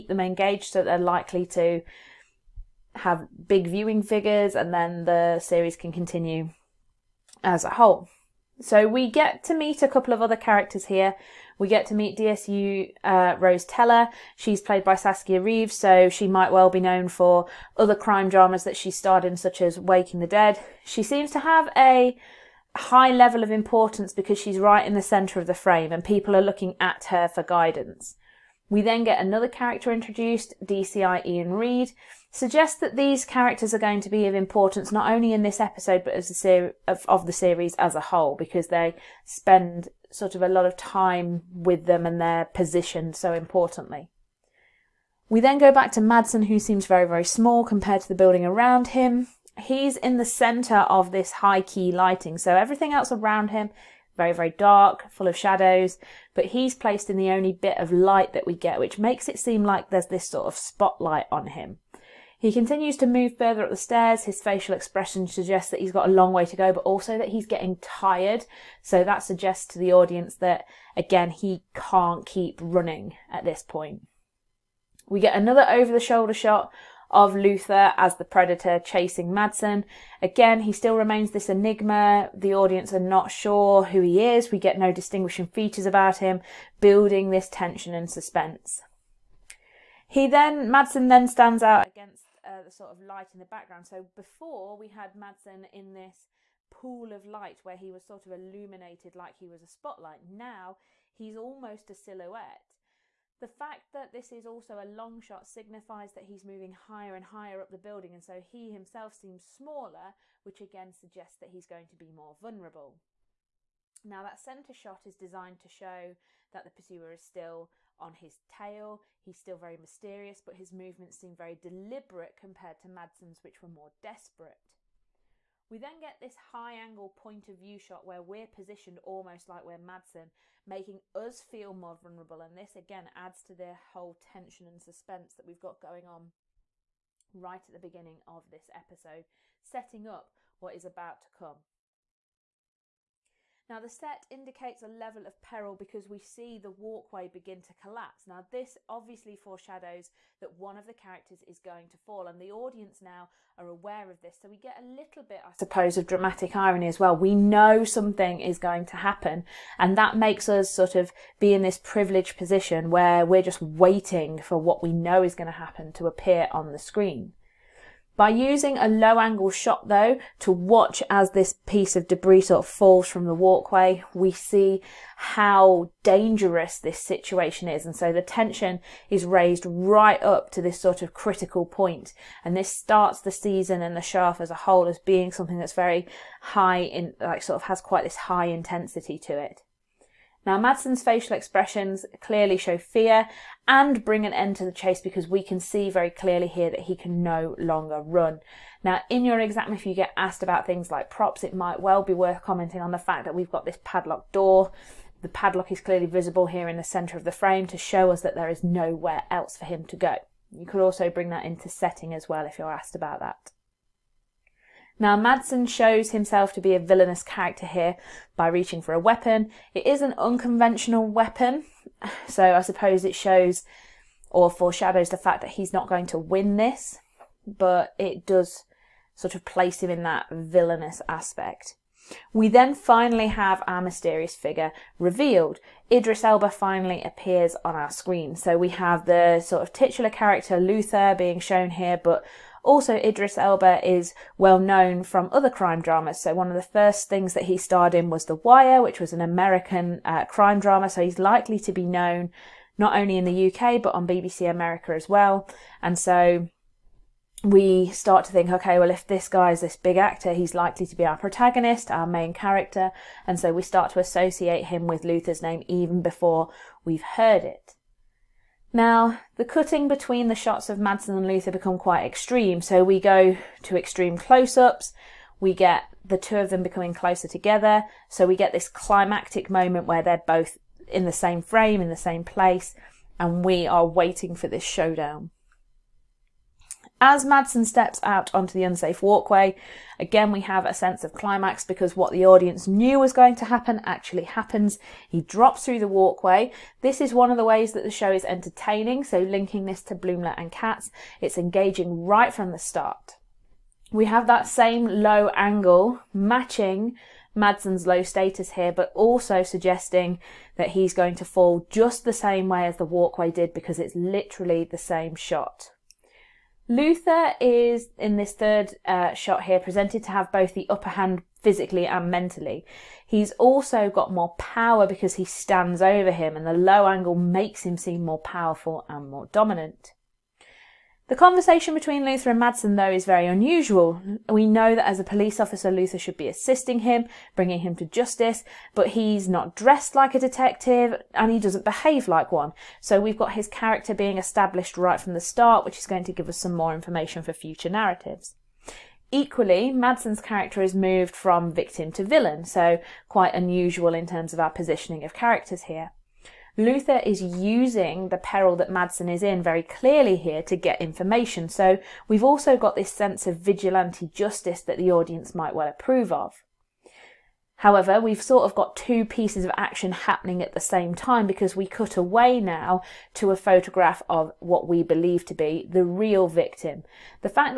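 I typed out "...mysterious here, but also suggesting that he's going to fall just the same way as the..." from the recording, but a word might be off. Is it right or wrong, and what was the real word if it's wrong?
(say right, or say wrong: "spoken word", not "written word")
wrong: "status", not "mysterious".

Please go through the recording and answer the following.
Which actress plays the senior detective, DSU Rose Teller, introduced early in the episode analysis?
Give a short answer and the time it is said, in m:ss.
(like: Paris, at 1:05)
Saskia Reeves, at 0:14.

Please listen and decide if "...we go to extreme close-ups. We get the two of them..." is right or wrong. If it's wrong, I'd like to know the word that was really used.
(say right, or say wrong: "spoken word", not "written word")
right.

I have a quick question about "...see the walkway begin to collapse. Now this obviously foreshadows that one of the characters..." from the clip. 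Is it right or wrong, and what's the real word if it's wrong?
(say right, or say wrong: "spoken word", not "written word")
right.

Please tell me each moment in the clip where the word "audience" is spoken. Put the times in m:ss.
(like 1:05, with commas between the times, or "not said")
1:09, 1:22, 2:32, 4:52, 6:04.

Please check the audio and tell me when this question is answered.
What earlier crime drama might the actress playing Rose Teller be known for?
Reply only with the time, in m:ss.
0:19.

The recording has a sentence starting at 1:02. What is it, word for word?
He continues to move further up the stairs.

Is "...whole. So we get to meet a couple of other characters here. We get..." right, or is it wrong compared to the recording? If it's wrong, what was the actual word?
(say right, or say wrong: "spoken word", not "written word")
right.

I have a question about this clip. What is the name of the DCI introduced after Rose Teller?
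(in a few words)
Ian Reed.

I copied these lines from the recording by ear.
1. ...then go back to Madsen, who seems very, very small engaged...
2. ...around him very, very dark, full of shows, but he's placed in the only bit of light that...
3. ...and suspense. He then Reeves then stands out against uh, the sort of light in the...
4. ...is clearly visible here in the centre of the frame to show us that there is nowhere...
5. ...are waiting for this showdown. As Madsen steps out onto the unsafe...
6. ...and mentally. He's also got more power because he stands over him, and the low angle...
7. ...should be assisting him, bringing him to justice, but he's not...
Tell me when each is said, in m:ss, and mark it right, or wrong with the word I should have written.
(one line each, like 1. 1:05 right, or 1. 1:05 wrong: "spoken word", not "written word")
1. 0:45 wrong: "compared", not "engaged"
2. 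0:53 wrong: "shadows", not "shows"
3. 1:27 wrong: "Madsen", not "Reeves"
4. 3:25 right
5. 4:43 right
6. 5:21 right
7. 5:35 right.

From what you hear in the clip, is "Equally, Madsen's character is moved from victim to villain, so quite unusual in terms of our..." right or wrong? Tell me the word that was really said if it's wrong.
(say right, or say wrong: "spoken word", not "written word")
right.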